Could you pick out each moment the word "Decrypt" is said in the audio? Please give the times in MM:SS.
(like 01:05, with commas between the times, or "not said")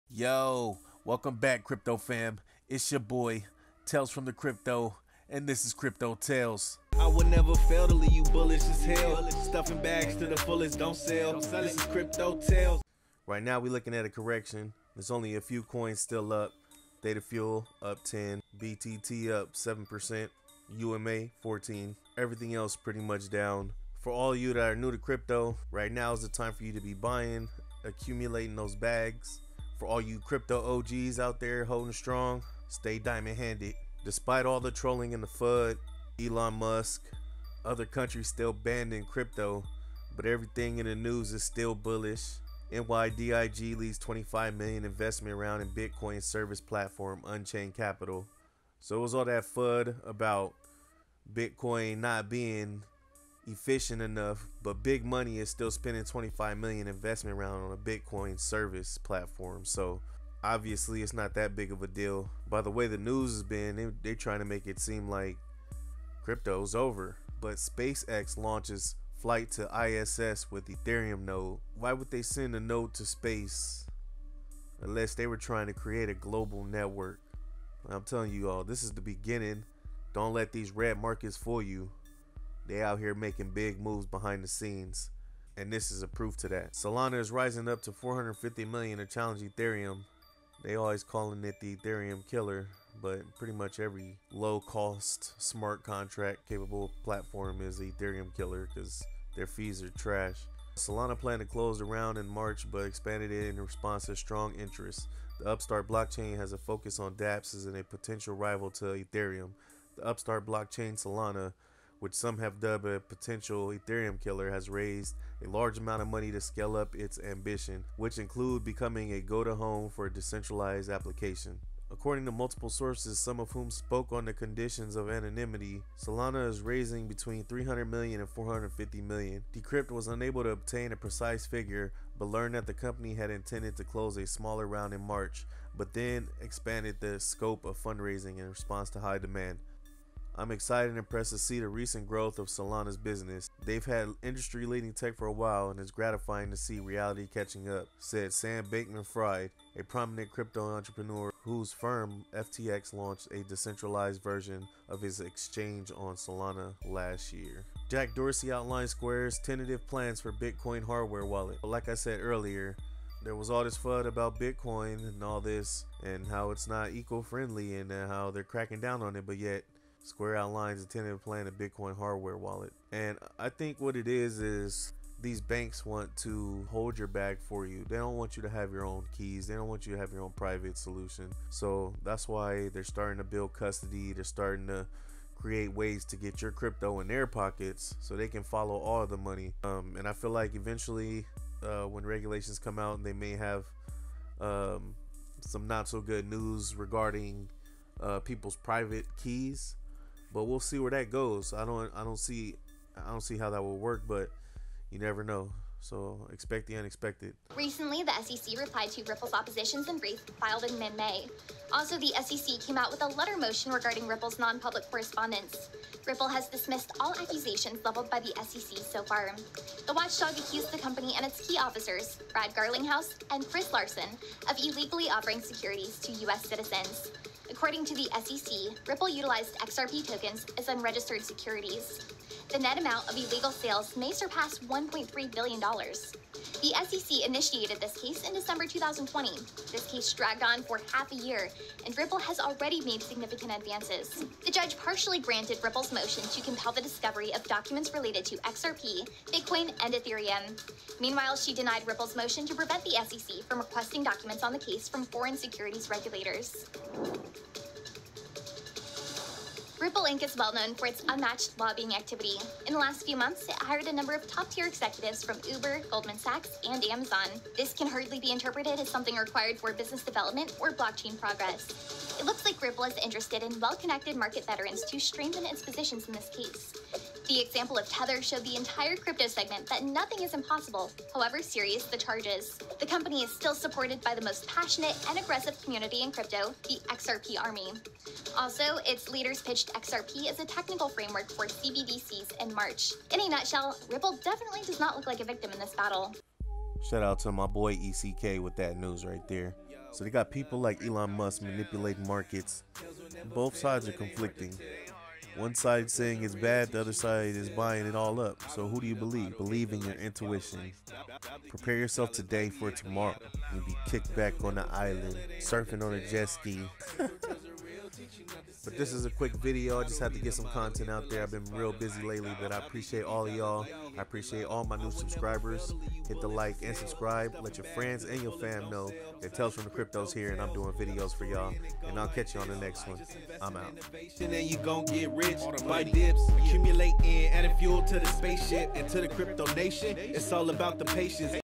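02:09.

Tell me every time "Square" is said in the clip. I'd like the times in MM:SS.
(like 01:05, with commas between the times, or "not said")
02:38, 02:50.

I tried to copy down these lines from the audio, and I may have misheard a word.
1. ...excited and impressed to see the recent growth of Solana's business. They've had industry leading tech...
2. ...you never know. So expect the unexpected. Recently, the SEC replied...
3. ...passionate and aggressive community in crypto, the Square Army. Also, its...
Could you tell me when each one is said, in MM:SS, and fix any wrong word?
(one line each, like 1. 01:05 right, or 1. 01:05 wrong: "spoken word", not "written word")
1. 02:20 right
2. 03:24 right
3. 04:44 wrong: "XRP", not "Square".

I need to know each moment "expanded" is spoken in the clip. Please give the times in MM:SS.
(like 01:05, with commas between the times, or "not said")
01:42, 02:16.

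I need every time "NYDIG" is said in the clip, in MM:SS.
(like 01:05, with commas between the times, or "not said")
00:42.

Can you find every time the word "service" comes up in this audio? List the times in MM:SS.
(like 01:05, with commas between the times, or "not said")
00:46, 00:58.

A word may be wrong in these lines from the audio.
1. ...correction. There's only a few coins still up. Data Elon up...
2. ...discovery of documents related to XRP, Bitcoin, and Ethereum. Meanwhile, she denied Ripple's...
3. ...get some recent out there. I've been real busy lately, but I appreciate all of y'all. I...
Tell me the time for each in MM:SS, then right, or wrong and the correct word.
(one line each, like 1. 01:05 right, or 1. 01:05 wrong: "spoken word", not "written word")
1. 00:14 wrong: "Fuel", not "Elon"
2. 04:06 right
3. 05:20 wrong: "content", not "recent".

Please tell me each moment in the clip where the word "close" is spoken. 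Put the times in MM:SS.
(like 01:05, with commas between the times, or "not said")
01:41, 02:13.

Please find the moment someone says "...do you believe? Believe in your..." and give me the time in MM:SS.
05:08.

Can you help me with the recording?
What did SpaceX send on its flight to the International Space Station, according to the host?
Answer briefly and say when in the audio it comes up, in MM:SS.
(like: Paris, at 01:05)
Ethereum node, at 01:10.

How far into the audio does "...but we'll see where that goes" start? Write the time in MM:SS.
03:20.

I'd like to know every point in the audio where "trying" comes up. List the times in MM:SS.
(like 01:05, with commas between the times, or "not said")
01:04, 01:15.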